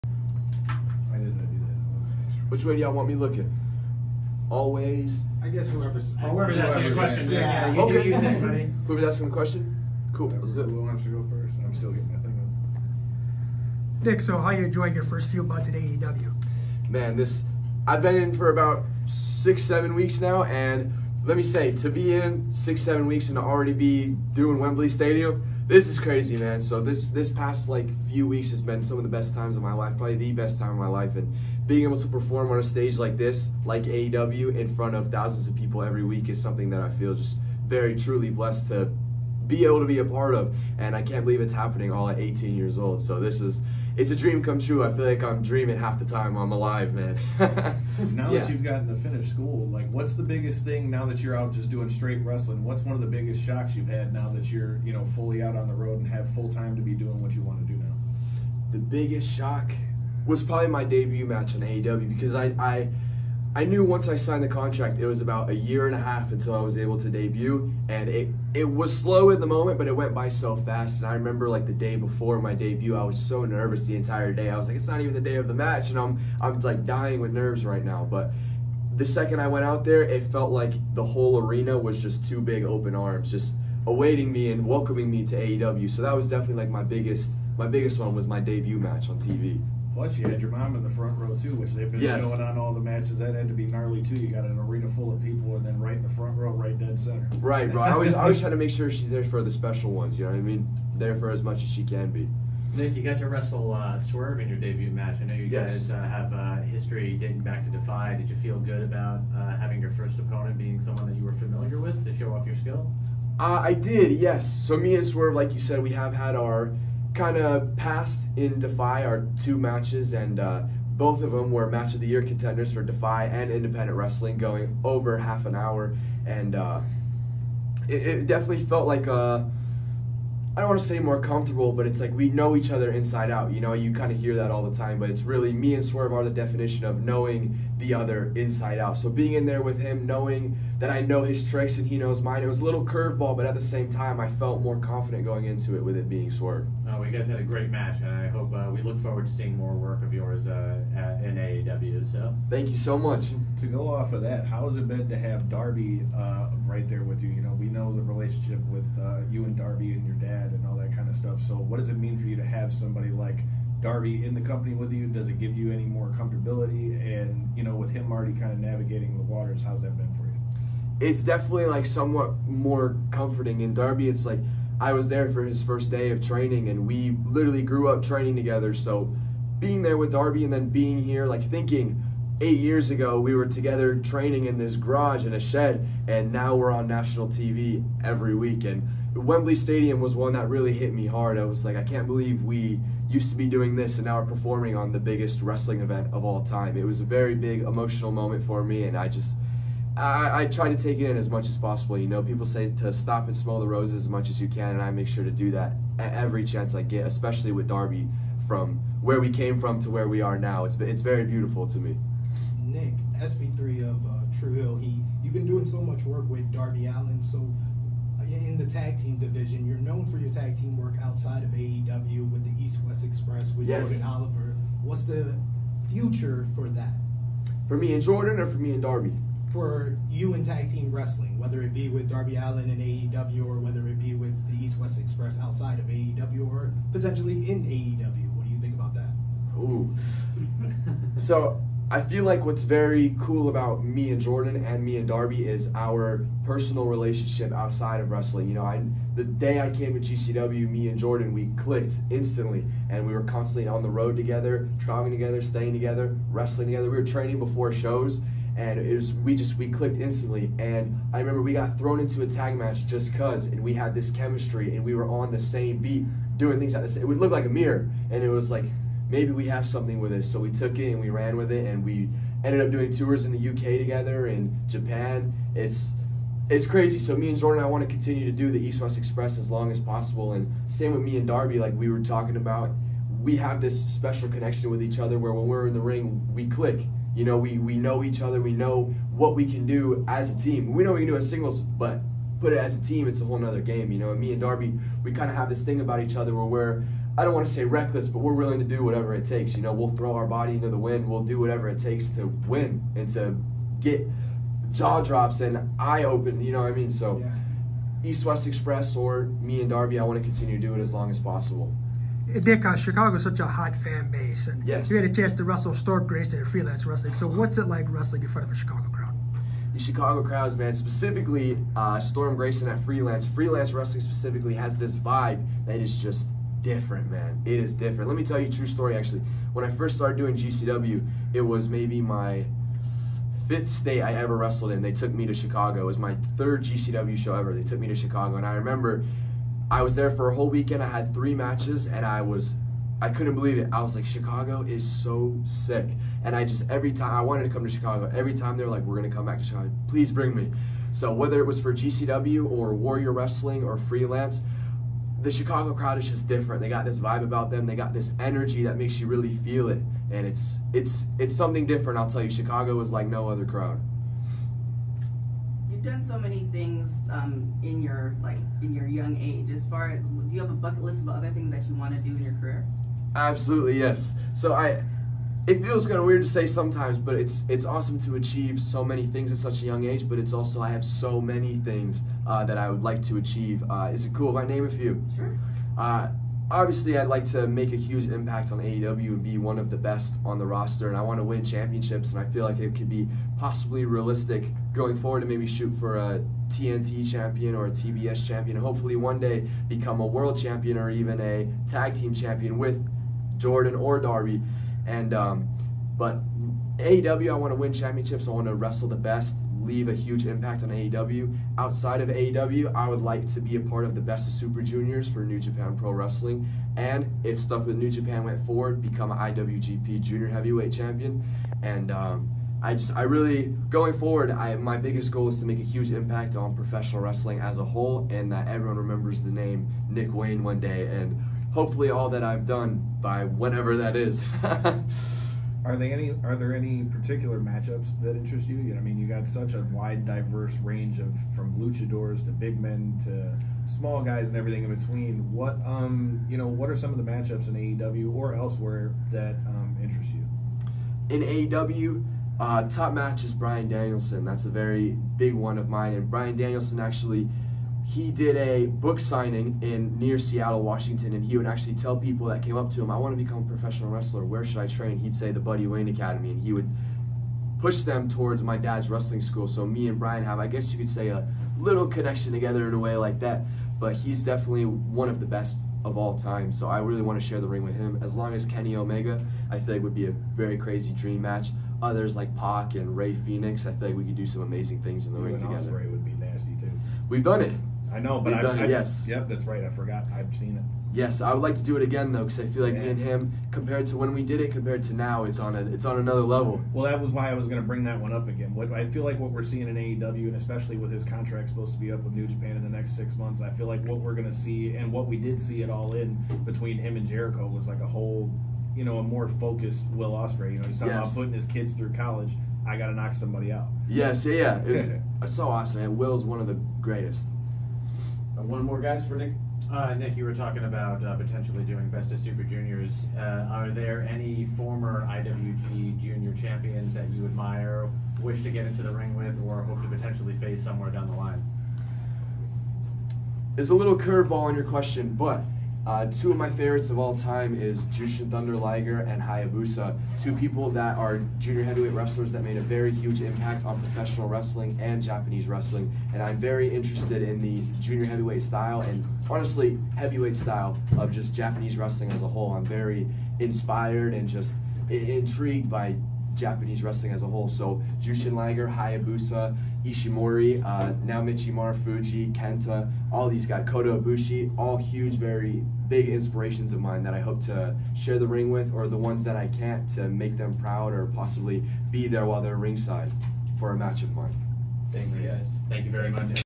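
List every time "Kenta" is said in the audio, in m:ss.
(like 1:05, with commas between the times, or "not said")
9:22.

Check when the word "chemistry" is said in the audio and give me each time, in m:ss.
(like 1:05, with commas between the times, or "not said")
4:24.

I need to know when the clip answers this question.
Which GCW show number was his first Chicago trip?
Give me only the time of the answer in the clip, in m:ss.
5:36.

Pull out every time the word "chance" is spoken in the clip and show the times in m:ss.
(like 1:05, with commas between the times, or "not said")
3:26, 5:15.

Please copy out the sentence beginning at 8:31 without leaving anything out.
about putting his kids through college.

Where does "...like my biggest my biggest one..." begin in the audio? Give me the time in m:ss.
1:26.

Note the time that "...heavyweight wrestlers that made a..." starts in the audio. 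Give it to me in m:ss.
9:01.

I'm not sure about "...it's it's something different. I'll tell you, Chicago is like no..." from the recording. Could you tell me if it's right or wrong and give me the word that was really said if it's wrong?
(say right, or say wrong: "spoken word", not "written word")
right.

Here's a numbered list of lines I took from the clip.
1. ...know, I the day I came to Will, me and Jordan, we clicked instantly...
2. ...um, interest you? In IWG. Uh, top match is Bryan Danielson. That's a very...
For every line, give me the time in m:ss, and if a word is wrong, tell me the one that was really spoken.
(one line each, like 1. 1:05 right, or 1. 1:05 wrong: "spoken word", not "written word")
1. 4:08 wrong: "GCW", not "Will"
2. 7:29 wrong: "AEW", not "IWG".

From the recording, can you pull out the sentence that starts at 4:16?
We were training before shows, and it was we just we clicked instantly.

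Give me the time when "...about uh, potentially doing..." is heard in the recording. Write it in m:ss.
8:40.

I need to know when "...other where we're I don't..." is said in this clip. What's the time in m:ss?
4:56.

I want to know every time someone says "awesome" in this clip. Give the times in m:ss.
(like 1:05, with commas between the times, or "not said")
6:17.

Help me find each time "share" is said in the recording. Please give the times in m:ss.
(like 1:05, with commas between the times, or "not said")
7:57, 9:27.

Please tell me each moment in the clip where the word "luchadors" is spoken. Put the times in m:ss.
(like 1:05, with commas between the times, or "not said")
7:21.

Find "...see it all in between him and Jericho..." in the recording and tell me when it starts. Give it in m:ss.
8:25.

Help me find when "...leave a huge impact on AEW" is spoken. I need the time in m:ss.
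6:49.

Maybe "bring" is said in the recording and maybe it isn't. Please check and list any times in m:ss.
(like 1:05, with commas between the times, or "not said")
5:50, 8:17.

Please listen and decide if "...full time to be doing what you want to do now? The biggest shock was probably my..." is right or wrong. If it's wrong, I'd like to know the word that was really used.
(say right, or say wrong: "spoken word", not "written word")
right.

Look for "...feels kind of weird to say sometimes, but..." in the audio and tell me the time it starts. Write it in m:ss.
6:15.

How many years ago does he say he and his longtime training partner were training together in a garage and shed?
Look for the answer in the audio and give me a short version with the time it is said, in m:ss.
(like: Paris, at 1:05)
8, at 3:02.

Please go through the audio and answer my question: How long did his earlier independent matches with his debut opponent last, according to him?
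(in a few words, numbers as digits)
Over half an hour.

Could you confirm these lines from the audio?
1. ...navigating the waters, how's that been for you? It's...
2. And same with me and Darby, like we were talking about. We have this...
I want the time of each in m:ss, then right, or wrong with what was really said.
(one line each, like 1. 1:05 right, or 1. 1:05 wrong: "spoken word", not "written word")
1. 2:48 right
2. 4:40 right.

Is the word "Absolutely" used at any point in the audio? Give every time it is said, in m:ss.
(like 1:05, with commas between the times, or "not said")
6:13.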